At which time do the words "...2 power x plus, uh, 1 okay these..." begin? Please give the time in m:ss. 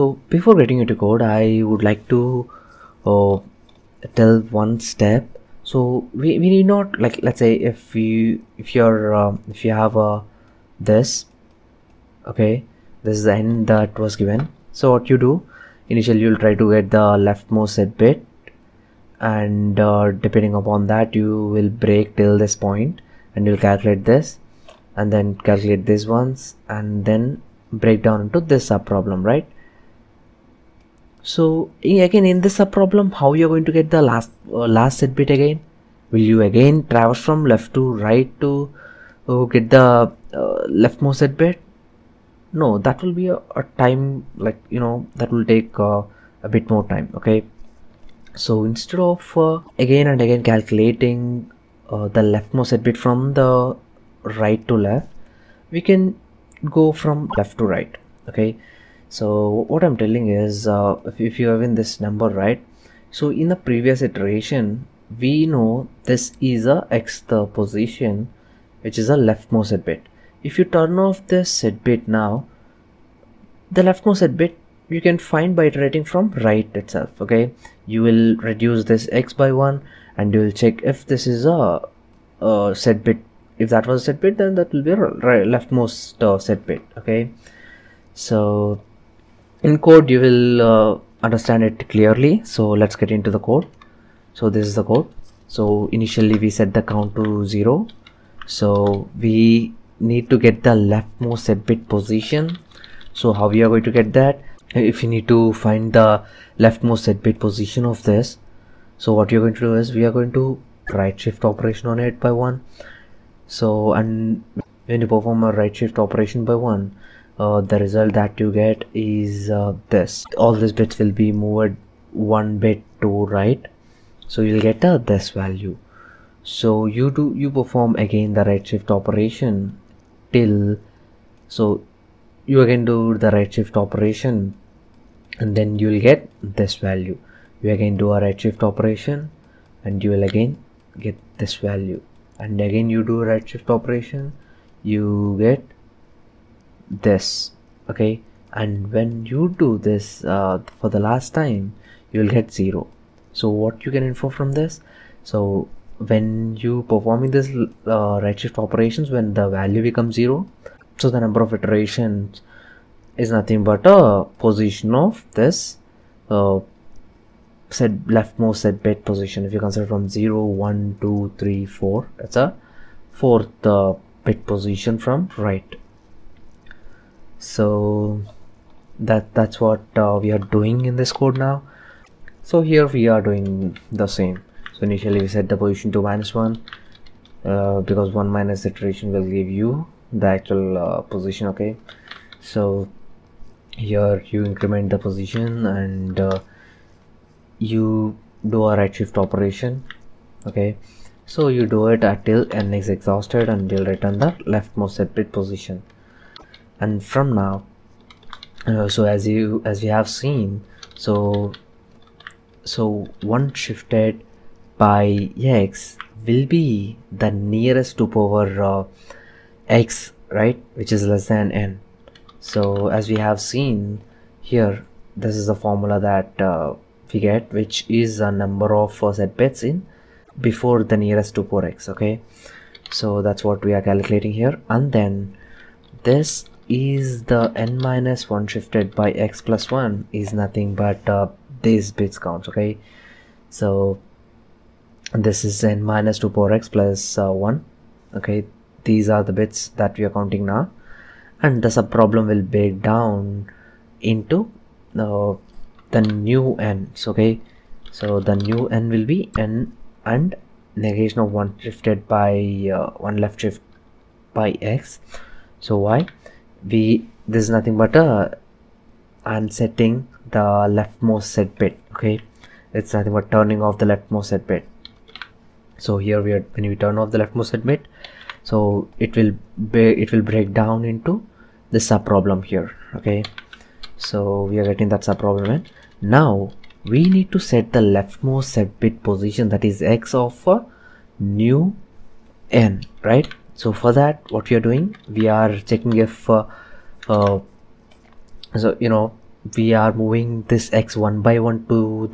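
4:06.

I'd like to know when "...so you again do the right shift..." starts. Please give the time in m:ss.
2:11.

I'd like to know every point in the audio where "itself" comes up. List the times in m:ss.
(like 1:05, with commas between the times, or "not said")
1:16.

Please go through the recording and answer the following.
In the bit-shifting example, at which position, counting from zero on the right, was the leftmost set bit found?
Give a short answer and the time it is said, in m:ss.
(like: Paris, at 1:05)
fourth, at 2:53.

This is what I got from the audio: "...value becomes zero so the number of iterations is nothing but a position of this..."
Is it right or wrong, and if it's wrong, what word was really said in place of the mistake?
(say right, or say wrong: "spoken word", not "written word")
right.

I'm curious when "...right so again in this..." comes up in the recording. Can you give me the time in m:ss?
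0:29.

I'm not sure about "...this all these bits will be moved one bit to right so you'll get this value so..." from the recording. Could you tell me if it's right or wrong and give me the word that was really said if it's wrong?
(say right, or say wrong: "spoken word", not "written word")
right.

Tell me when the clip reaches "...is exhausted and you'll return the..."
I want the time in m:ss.
3:22.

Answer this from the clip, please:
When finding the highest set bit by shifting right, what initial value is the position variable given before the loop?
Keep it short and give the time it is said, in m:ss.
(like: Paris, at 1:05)
-1, at 3:06.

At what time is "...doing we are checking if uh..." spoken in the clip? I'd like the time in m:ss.
4:54.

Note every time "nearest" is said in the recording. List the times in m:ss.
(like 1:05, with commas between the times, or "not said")
3:37, 3:50.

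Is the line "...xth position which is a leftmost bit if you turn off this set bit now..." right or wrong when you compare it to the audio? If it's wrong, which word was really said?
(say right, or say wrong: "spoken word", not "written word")
right.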